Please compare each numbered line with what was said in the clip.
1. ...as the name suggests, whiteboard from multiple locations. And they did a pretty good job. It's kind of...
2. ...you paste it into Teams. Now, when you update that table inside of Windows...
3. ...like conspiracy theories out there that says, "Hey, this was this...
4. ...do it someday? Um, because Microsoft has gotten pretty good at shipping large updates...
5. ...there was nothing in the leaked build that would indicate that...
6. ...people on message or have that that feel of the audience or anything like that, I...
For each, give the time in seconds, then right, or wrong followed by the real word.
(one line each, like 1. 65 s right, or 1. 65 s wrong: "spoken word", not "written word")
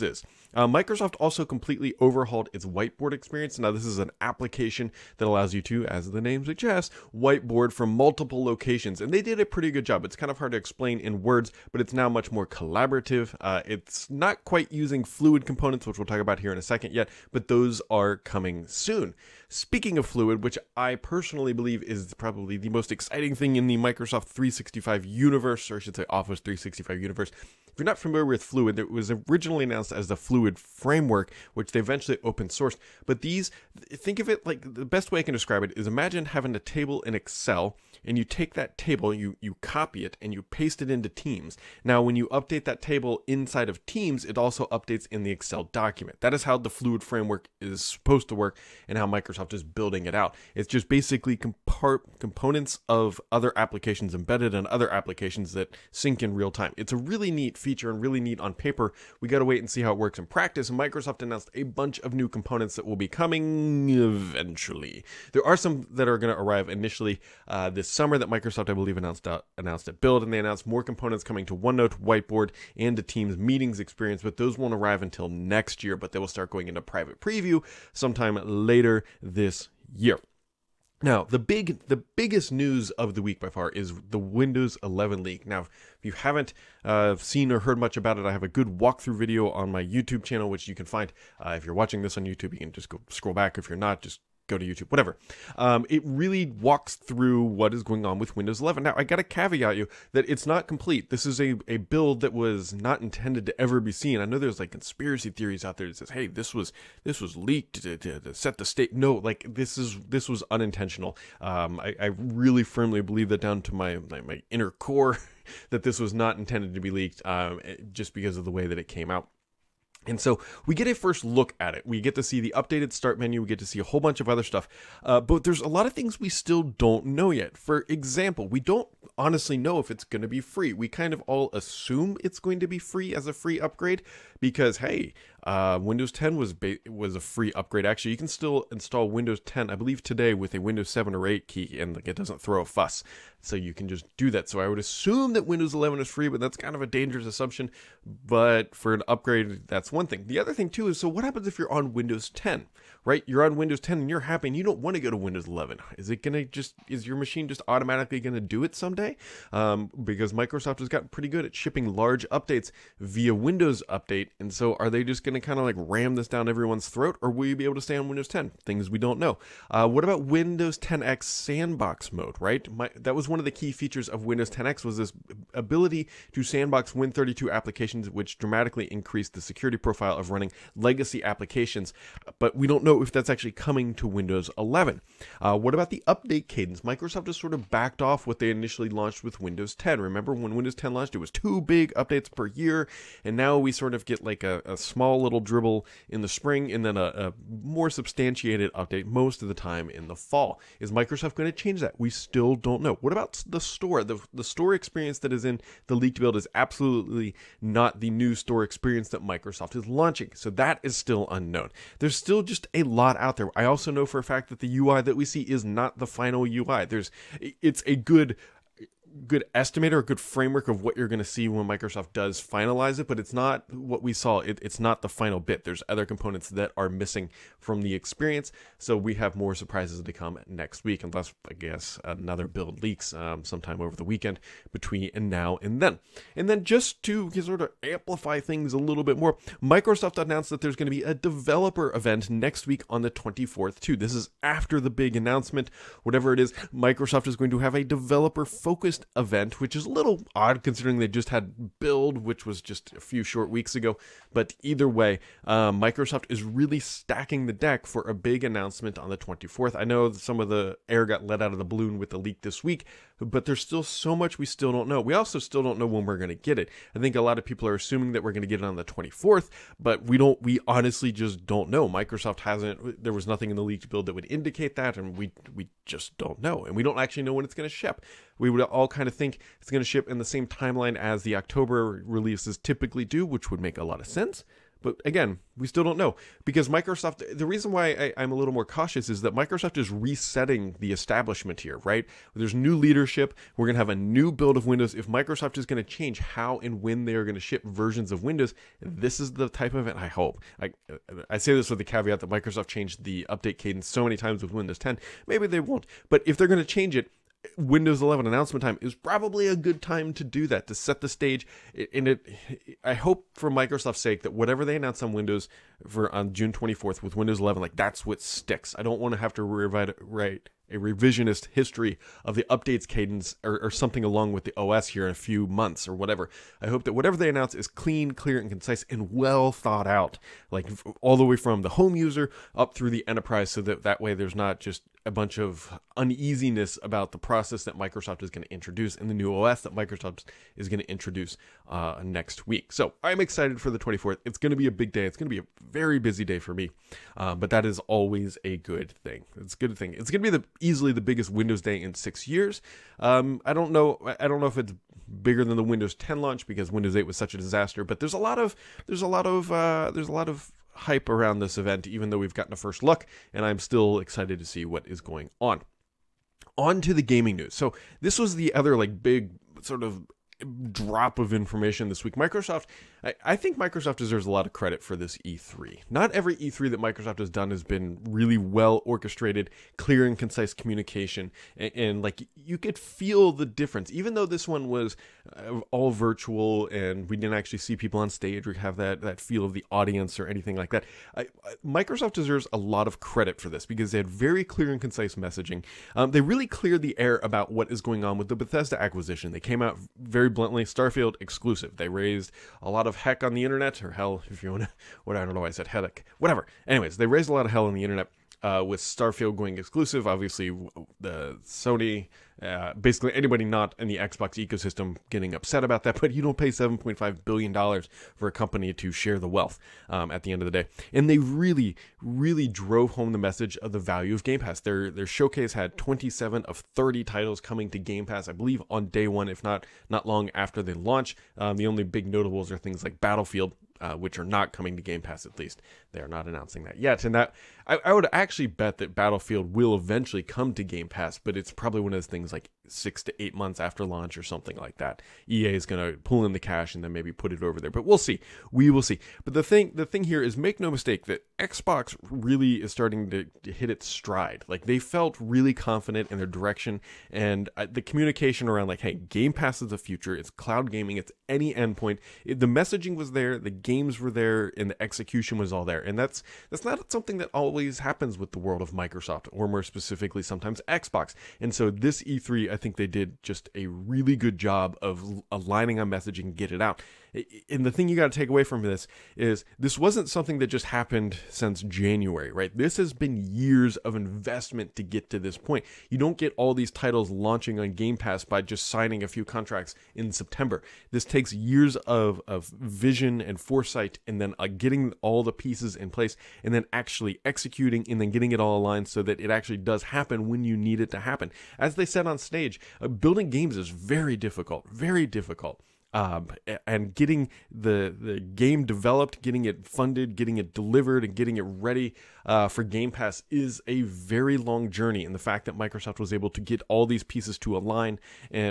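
1. 5 s right
2. 40 s wrong: "Teams", not "Windows"
3. 104 s right
4. 158 s right
5. 273 s right
6. 387 s wrong: "stage", not "message".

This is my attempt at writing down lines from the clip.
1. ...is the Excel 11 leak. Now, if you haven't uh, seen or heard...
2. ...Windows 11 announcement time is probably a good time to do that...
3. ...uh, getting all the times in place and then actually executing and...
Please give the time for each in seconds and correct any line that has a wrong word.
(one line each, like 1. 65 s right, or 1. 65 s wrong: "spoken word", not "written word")
1. 83 s wrong: "Windows", not "Excel"
2. 307 s right
3. 494 s wrong: "pieces", not "times".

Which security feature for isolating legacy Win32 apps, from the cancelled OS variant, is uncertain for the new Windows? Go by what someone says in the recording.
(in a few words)
sandbox mode.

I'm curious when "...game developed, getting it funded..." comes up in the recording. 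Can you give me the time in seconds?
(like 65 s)
508 s.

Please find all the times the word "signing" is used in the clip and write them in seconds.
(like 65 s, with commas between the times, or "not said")
488 s.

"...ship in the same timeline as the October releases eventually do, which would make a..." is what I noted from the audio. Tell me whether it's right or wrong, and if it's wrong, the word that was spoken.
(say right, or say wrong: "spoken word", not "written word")
wrong: "typically", not "eventually".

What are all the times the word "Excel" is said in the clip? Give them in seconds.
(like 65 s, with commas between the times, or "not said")
37 s, 45 s.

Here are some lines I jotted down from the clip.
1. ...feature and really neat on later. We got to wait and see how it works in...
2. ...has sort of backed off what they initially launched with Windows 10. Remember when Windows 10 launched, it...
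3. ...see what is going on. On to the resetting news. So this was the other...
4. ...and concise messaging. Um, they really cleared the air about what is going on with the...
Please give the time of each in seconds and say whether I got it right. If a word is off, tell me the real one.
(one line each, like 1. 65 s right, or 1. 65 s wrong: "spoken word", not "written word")
1. 57 s wrong: "paper", not "later"
2. 187 s right
3. 364 s wrong: "gaming", not "resetting"
4. 394 s right.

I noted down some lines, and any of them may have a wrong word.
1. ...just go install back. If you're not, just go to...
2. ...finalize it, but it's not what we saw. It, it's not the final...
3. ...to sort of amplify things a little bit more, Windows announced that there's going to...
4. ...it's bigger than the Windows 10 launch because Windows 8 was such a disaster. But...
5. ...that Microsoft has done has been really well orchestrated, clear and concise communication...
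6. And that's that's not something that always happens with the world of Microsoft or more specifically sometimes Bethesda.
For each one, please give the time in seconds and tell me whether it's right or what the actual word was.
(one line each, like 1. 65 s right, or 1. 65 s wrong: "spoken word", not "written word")
1. 92 s wrong: "scroll", not "install"
2. 222 s right
3. 237 s wrong: "Microsoft", not "Windows"
4. 354 s right
5. 376 s right
6. 465 s wrong: "Xbox", not "Bethesda".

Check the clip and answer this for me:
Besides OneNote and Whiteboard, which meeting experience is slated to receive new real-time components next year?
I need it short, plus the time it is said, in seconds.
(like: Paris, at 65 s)
Teams Meetings, at 73 s.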